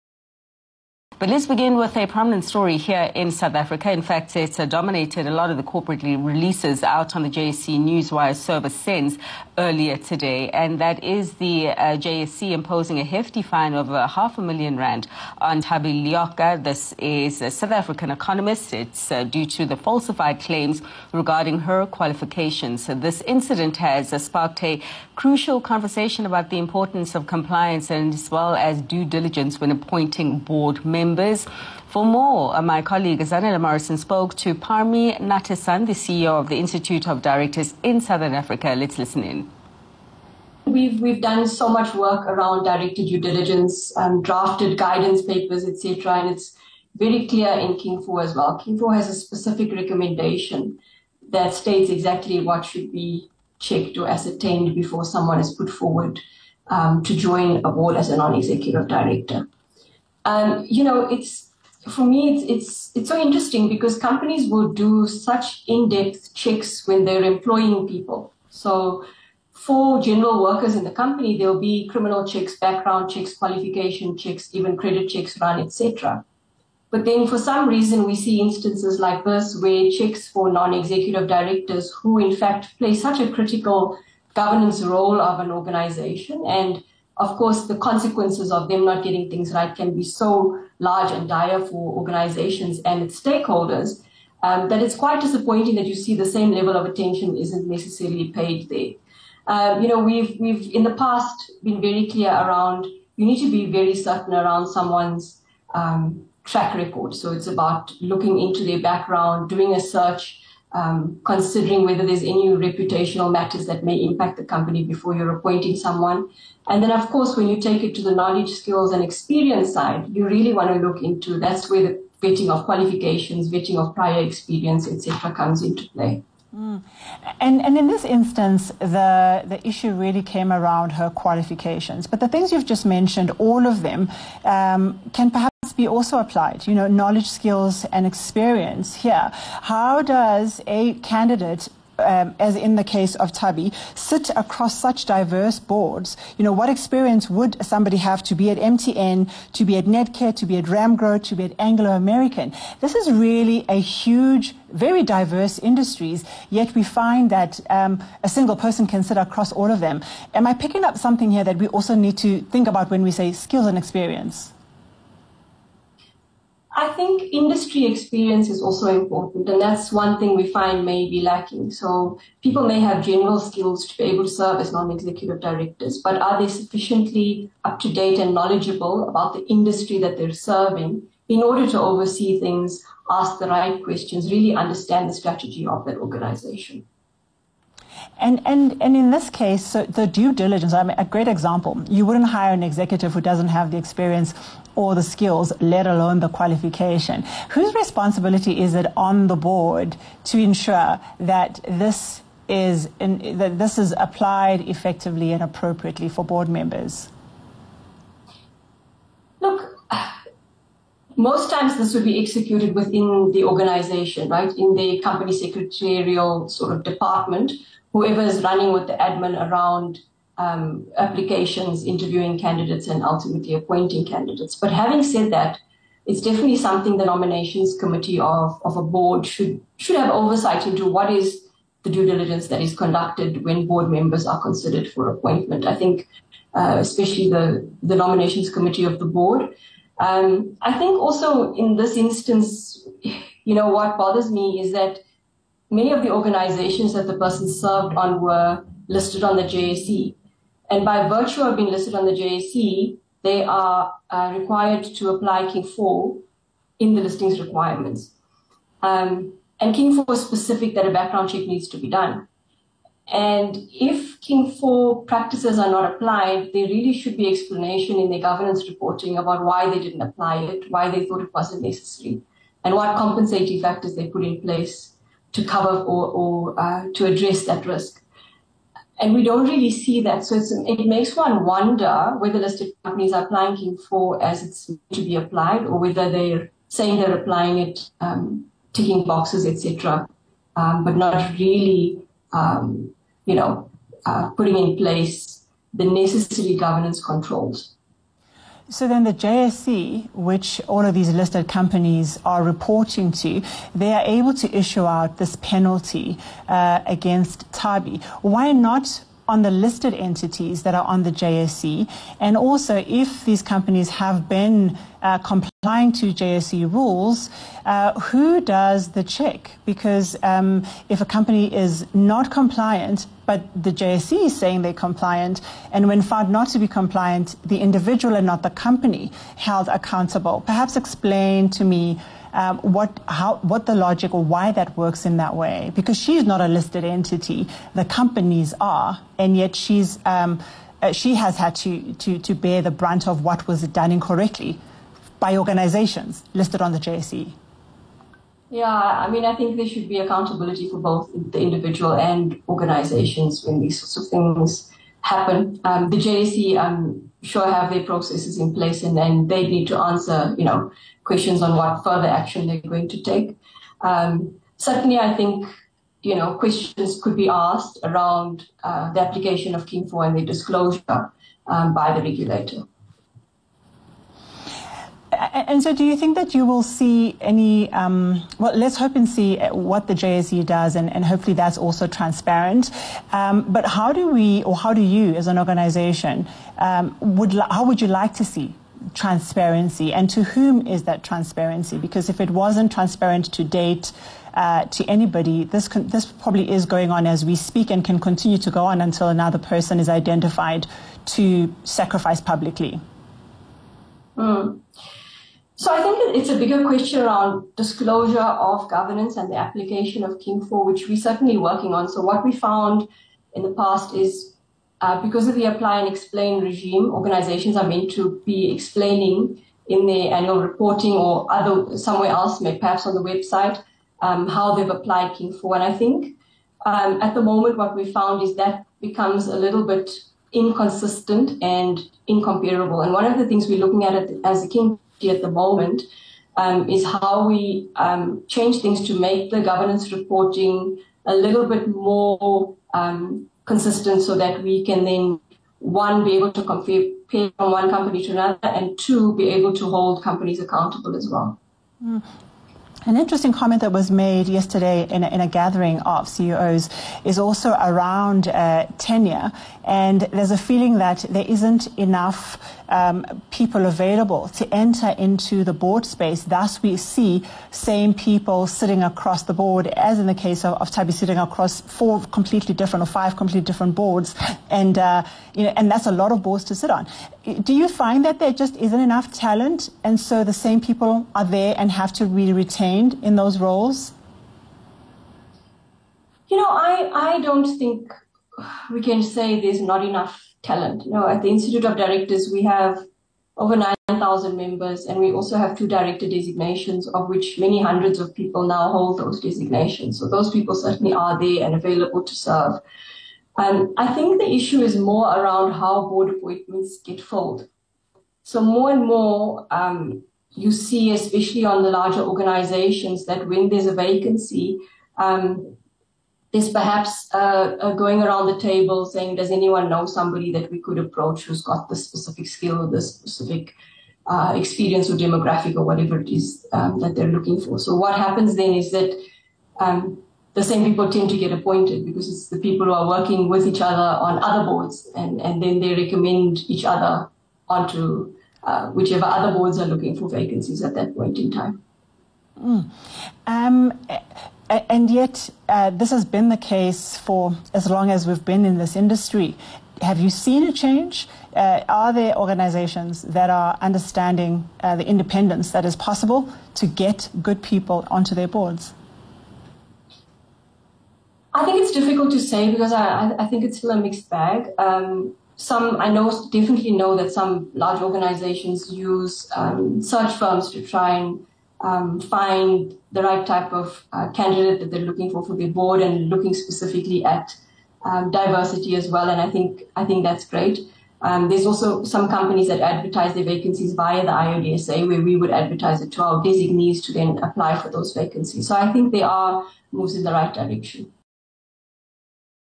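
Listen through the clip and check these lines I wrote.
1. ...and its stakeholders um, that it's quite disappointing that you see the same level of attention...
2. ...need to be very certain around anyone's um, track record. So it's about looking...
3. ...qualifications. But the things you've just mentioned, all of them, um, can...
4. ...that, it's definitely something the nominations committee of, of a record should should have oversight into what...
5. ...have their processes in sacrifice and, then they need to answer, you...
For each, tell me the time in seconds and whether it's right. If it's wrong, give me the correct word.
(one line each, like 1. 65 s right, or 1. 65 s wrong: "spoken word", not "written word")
1. 92 s right
2. 103 s wrong: "someone", not "anyone"
3. 131 s right
4. 225 s wrong: "board", not "record"
5. 357 s wrong: "place", not "sacrifice".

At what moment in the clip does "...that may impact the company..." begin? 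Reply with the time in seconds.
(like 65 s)
113 s.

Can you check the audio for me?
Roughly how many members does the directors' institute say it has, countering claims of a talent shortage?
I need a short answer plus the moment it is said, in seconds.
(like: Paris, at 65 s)
9,000, at 493 s.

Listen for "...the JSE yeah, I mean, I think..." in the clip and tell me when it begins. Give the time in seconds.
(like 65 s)
346 s.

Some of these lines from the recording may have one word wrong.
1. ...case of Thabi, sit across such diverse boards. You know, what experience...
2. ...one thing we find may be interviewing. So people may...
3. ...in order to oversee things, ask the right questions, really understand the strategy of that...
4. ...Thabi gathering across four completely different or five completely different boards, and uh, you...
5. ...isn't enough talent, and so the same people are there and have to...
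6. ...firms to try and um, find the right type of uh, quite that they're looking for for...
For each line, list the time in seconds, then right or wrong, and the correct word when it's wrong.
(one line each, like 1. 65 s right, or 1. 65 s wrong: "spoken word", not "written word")
1. 142 s right
2. 169 s wrong: "lacking", not "interviewing"
3. 181 s right
4. 470 s wrong: "sitting", not "gathering"
5. 478 s right
6. 570 s wrong: "candidate", not "quite".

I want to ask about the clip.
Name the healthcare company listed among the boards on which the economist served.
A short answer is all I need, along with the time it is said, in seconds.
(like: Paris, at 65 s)
Netcare, at 149 s.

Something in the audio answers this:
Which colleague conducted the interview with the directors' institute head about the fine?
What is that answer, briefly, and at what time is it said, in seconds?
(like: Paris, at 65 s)
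Zanele Morrison, at 33 s.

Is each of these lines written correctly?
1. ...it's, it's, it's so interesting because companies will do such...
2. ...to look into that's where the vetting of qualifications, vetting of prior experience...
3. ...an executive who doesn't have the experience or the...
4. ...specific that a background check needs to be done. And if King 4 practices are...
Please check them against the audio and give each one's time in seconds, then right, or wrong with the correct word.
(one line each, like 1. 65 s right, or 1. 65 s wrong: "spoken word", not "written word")
1. 62 s right
2. 120 s right
3. 192 s right
4. 260 s right.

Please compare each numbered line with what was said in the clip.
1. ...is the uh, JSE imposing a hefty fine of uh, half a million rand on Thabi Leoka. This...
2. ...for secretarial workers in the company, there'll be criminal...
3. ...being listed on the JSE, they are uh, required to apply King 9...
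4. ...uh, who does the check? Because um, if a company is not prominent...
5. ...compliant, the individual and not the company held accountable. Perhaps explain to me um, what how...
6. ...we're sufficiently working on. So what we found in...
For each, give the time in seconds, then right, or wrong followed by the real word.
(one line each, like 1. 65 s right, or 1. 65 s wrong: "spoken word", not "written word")
1. 11 s right
2. 69 s wrong: "general", not "secretarial"
3. 251 s wrong: "4", not "9"
4. 317 s wrong: "compliant", not "prominent"
5. 326 s right
6. 410 s wrong: "certainly", not "sufficiently".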